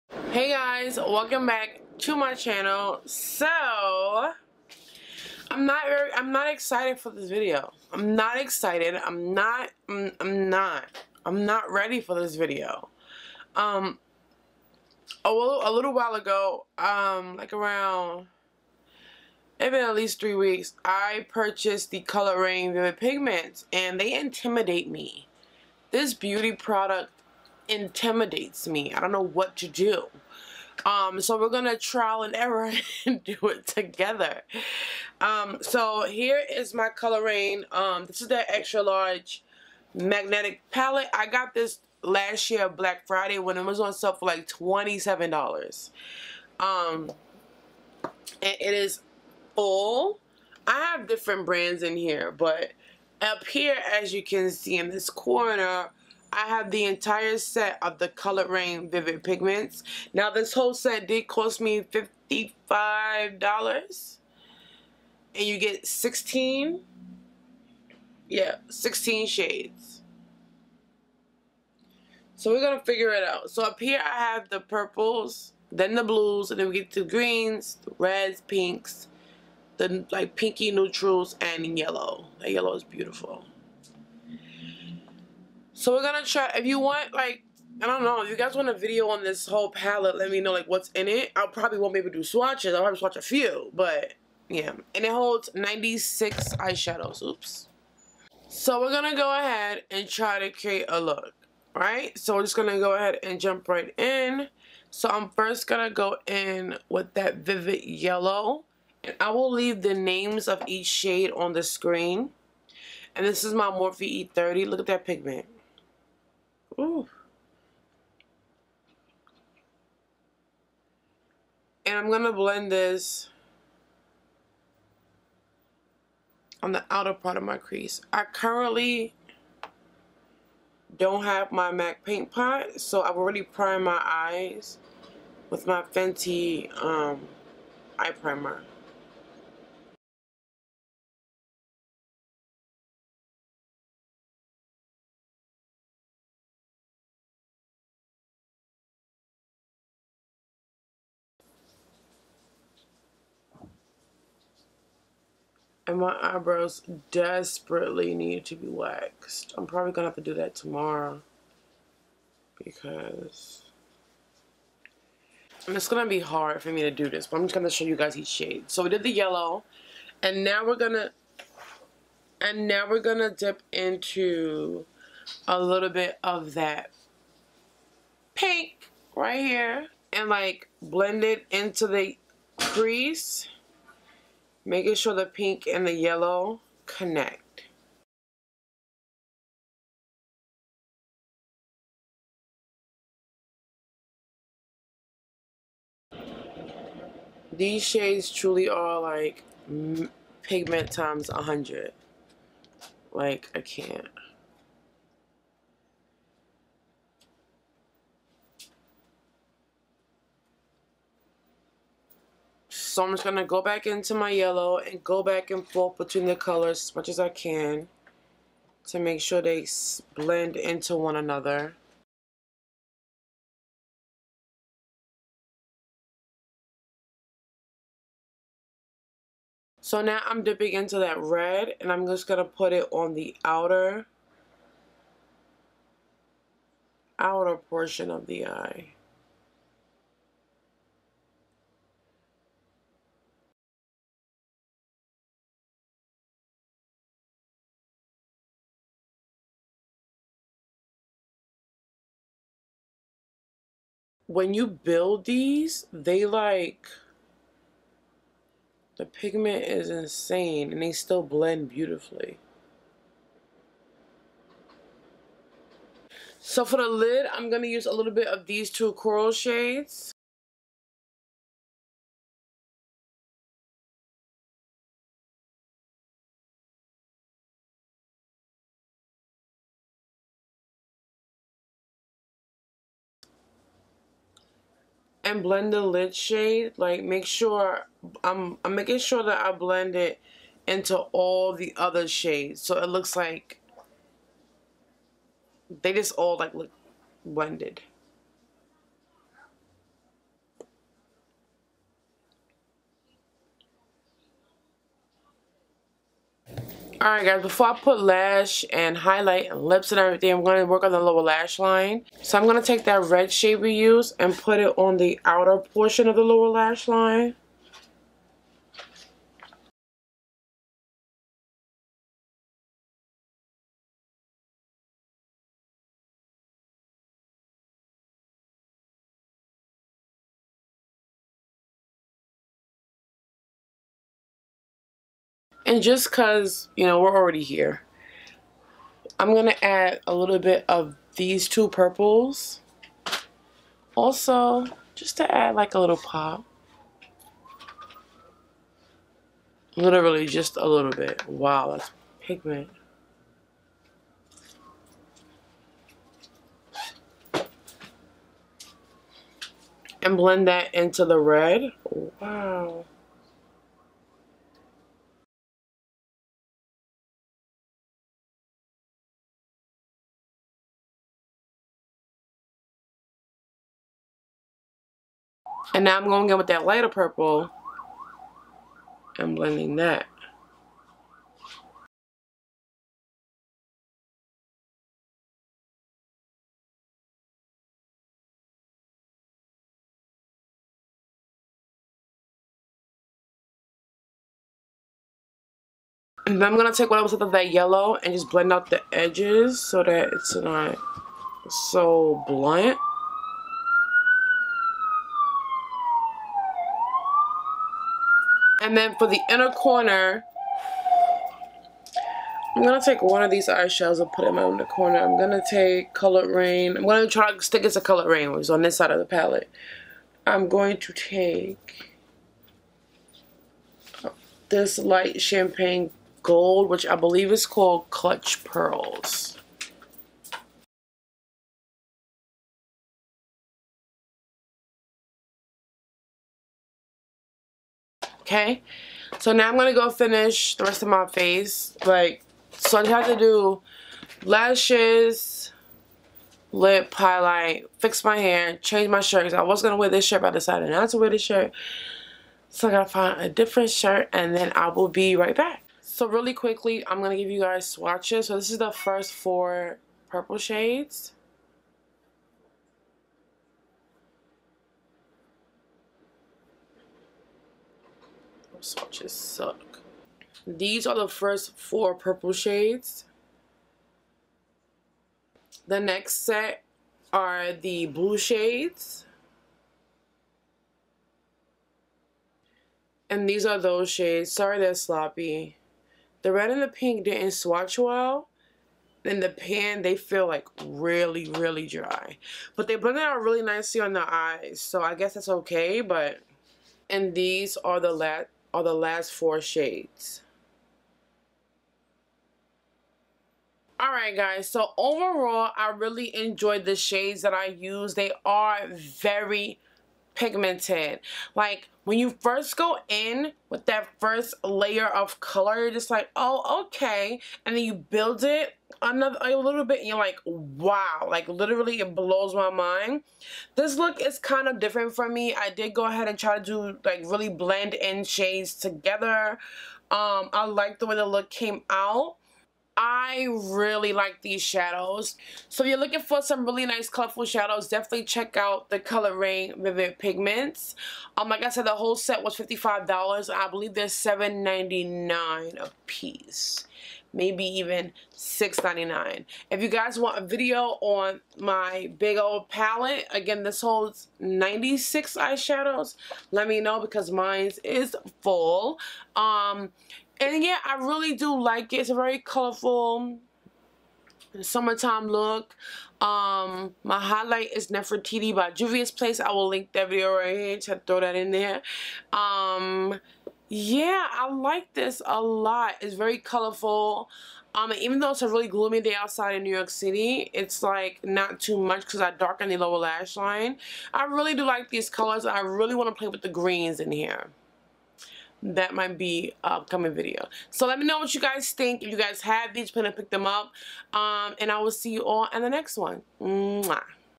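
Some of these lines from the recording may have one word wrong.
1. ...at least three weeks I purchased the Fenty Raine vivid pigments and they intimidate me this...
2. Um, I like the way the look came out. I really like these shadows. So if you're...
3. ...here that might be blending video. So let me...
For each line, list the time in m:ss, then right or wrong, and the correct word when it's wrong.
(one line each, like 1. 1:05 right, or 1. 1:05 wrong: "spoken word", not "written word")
1. 0:19 wrong: "Coloured", not "Fenty"
2. 8:49 right
3. 9:46 wrong: "upcoming", not "blending".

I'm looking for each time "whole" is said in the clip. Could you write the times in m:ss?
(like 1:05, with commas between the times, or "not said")
1:00, 1:29, 9:01.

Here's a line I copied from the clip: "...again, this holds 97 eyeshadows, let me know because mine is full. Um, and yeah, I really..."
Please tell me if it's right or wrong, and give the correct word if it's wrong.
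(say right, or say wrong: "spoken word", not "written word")
wrong: "96", not "97".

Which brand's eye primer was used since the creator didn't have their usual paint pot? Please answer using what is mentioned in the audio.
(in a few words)
Fenty.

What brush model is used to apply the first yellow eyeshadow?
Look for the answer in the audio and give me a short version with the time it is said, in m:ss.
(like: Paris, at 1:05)
Morphe E30, at 1:53.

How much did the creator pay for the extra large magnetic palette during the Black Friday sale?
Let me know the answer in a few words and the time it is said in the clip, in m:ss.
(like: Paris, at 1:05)
$27, at 0:44.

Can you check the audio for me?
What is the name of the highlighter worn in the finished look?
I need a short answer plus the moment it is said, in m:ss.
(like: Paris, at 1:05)
Nefertiti, at 9:27.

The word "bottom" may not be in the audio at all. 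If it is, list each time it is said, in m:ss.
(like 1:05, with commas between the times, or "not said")
not said.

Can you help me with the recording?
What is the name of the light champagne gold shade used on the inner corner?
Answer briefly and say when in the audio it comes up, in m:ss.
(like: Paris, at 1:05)
Clutched Pearls, at 7:07.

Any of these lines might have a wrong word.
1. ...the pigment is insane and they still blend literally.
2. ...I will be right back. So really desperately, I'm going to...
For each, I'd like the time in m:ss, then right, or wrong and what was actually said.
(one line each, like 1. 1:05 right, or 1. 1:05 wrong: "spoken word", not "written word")
1. 4:18 wrong: "beautifully", not "literally"
2. 7:34 wrong: "quickly", not "desperately".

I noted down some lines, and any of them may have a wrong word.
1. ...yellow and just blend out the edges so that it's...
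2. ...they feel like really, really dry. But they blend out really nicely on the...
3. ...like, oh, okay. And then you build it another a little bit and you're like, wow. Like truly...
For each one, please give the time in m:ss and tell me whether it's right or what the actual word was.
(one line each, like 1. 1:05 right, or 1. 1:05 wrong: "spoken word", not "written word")
1. 6:37 right
2. 8:09 right
3. 8:35 wrong: "literally", not "truly".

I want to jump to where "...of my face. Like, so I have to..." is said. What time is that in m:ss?
7:20.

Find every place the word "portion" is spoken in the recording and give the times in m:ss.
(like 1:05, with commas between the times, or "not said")
3:57, 5:15.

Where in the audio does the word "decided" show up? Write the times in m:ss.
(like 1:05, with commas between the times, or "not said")
7:30.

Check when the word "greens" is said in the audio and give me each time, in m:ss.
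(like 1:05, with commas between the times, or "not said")
1:17, 9:46.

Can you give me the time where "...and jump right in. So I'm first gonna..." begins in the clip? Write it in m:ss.
1:43.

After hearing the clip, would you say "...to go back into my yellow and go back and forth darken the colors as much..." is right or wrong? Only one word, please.
wrong.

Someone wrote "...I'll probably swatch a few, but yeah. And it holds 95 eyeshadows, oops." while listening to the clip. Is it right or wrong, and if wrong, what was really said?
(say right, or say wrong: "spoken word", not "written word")
wrong: "96", not "95".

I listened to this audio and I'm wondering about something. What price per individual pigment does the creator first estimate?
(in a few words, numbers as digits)
$7.99.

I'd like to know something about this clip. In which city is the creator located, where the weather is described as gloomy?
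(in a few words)
New York City.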